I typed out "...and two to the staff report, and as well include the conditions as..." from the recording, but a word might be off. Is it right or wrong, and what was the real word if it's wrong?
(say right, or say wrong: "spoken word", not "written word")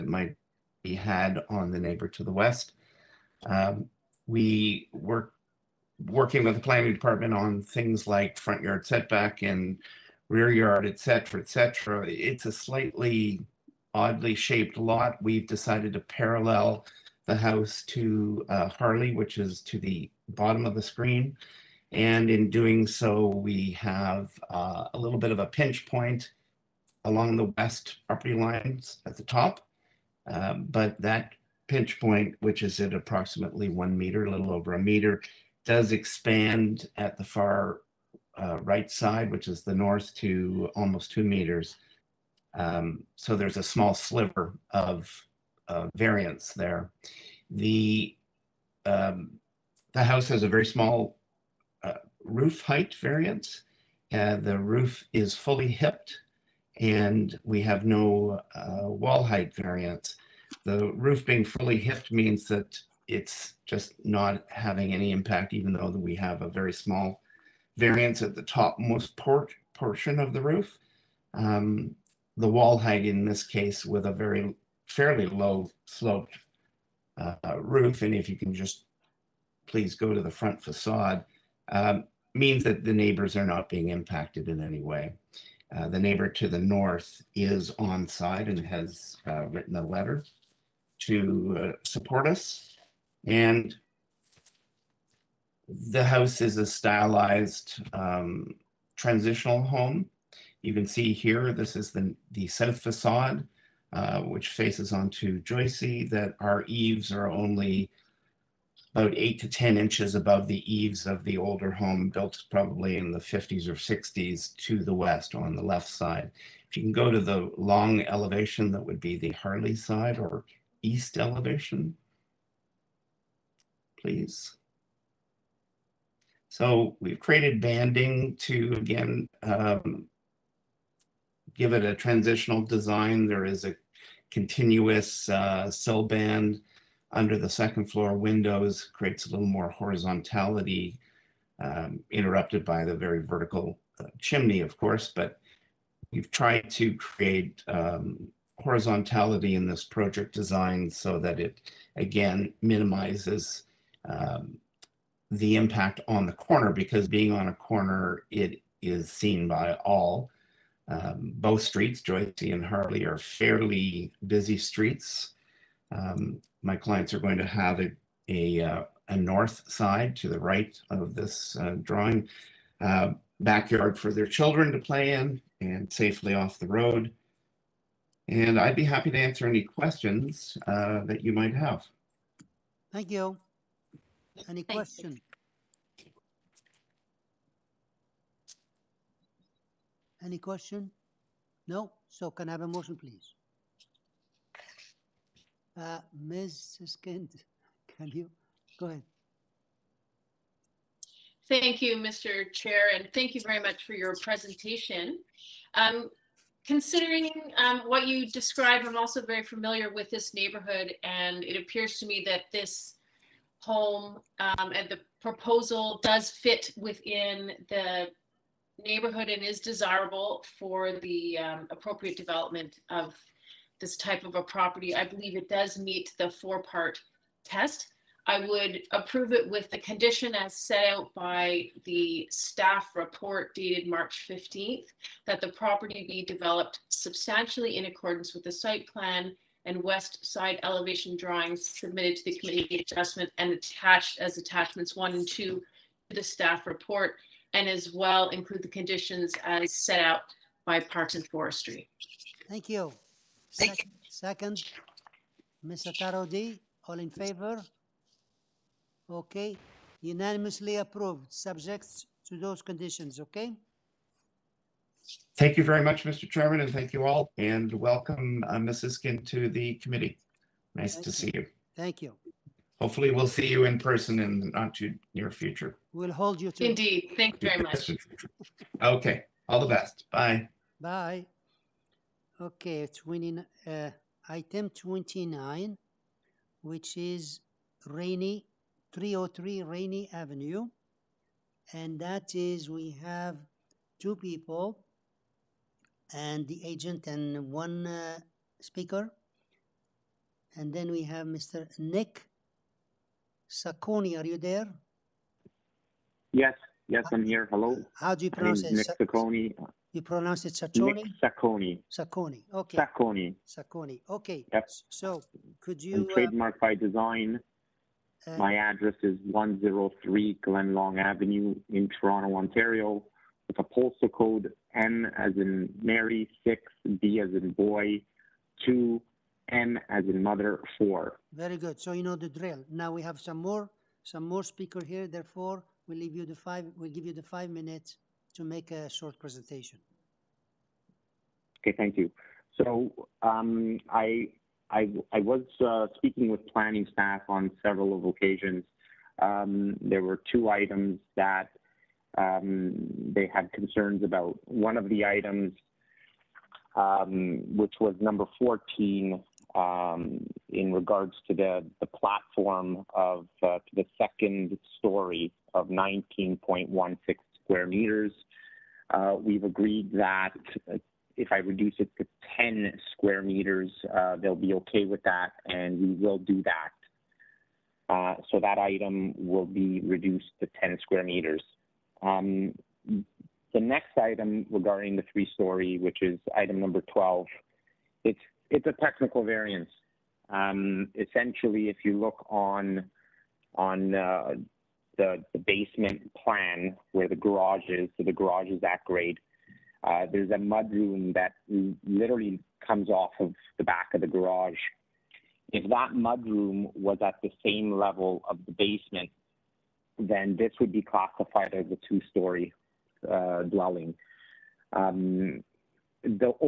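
right.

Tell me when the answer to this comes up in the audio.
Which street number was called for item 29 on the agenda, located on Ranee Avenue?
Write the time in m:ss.
4:48.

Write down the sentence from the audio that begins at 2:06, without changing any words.
So we've created banding to, again, um, give it a transitional design.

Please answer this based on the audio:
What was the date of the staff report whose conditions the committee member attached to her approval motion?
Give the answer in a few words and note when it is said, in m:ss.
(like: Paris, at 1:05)
March 15th, at 3:53.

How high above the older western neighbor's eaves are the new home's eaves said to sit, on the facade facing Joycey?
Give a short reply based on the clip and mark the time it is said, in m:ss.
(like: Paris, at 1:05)
8 to 10 inches, at 1:49.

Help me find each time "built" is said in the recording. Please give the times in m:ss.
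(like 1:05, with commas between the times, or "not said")
1:52.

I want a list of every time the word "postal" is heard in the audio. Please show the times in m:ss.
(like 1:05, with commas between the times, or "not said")
5:23.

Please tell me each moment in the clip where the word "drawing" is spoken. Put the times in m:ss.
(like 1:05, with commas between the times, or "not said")
2:51, 4:01.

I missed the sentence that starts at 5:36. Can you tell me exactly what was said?
We we'll give you the five minutes to make a short presentation.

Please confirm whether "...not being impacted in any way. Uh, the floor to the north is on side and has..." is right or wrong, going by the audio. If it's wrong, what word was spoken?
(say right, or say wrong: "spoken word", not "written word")
wrong: "neighbor", not "floor".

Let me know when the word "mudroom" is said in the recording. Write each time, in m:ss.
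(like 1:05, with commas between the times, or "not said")
6:40, 6:45.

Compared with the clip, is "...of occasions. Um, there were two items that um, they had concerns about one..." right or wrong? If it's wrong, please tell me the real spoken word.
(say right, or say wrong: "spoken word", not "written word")
right.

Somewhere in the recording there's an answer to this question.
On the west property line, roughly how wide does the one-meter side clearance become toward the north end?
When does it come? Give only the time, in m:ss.
0:40.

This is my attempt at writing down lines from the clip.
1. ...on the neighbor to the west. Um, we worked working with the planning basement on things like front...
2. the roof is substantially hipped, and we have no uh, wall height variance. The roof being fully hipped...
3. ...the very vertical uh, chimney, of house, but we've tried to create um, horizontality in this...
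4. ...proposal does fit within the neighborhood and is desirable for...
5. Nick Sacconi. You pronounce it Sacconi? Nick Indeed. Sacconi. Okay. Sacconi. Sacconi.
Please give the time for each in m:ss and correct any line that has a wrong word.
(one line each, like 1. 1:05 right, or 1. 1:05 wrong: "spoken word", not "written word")
1. 0:01 wrong: "department", not "basement"
2. 0:54 wrong: "fully", not "substantially"
3. 2:22 wrong: "course", not "house"
4. 3:35 right
5. 5:08 wrong: "Sacconi", not "Indeed".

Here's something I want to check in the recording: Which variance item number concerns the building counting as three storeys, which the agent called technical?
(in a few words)
12.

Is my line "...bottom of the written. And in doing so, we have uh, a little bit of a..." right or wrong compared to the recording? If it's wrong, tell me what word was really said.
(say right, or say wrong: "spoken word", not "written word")
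wrong: "screen", not "written".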